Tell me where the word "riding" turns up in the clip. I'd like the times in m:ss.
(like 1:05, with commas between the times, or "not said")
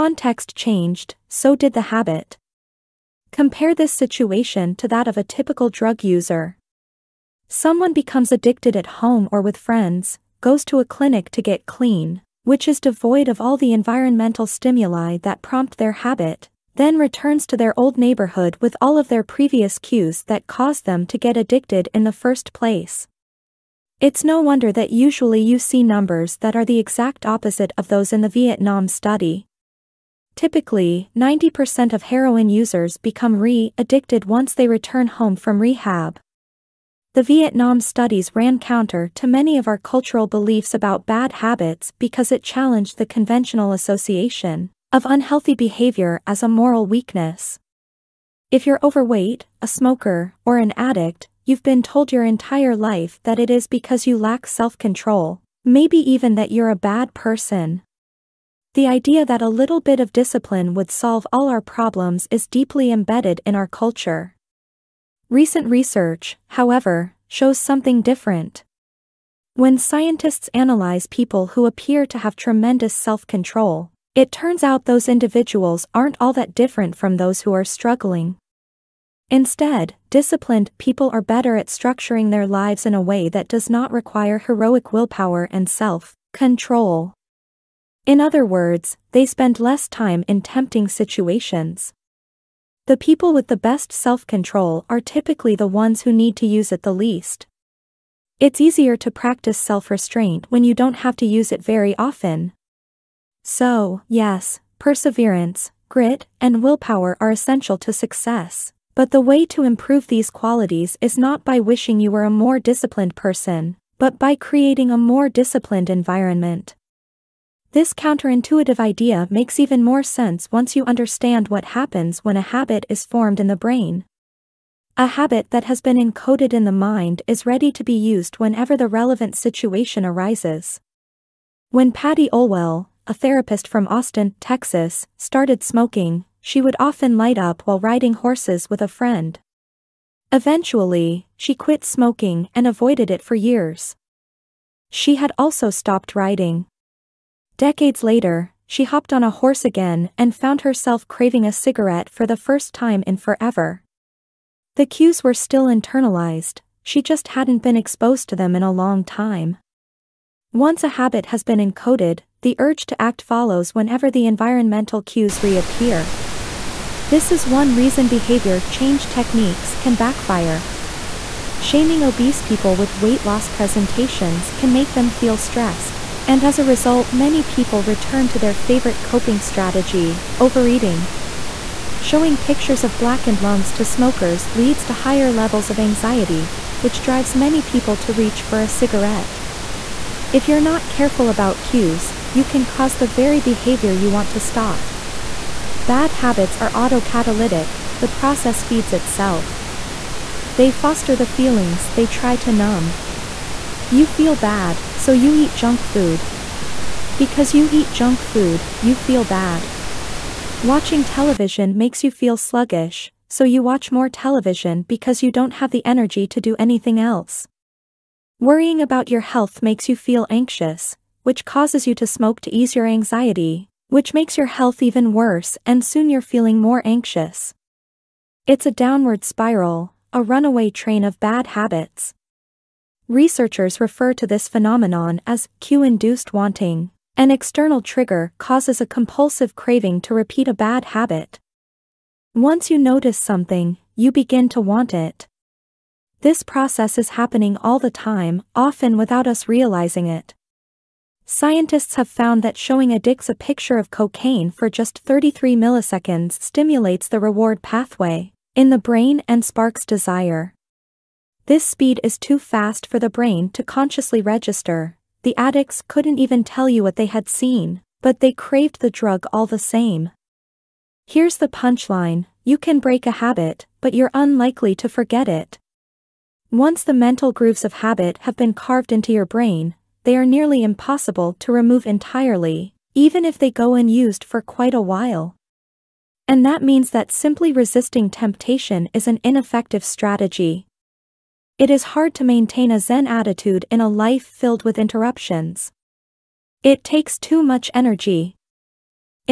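2:17, 2:26.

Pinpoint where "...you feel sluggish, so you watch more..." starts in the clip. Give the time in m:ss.
3:32.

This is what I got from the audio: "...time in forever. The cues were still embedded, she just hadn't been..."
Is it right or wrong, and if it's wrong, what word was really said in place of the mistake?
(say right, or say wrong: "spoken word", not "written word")
wrong: "internalized", not "embedded".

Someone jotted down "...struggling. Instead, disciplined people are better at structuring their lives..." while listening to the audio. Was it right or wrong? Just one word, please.
right.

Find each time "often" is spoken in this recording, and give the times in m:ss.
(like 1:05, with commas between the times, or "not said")
1:41, 2:16, 4:08.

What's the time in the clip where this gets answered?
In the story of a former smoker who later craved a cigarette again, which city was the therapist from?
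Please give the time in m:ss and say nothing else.
2:13.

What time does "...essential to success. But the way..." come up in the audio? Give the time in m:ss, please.
1:47.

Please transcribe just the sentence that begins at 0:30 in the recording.
Typically, 90% of heroin users become re-addicted once they return home from rehab.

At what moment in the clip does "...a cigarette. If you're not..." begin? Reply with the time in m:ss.
3:08.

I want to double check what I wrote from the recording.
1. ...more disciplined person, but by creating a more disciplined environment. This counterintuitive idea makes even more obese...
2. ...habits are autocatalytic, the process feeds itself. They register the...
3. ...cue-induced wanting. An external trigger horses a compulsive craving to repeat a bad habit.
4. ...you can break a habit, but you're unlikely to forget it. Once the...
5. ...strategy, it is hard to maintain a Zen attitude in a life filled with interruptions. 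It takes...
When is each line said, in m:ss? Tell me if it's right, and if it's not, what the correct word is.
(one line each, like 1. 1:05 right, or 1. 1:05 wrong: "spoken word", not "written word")
1. 1:52 wrong: "sense", not "obese"
2. 3:16 wrong: "foster", not "register"
3. 3:55 wrong: "causes", not "horses"
4. 4:32 right
5. 4:49 right.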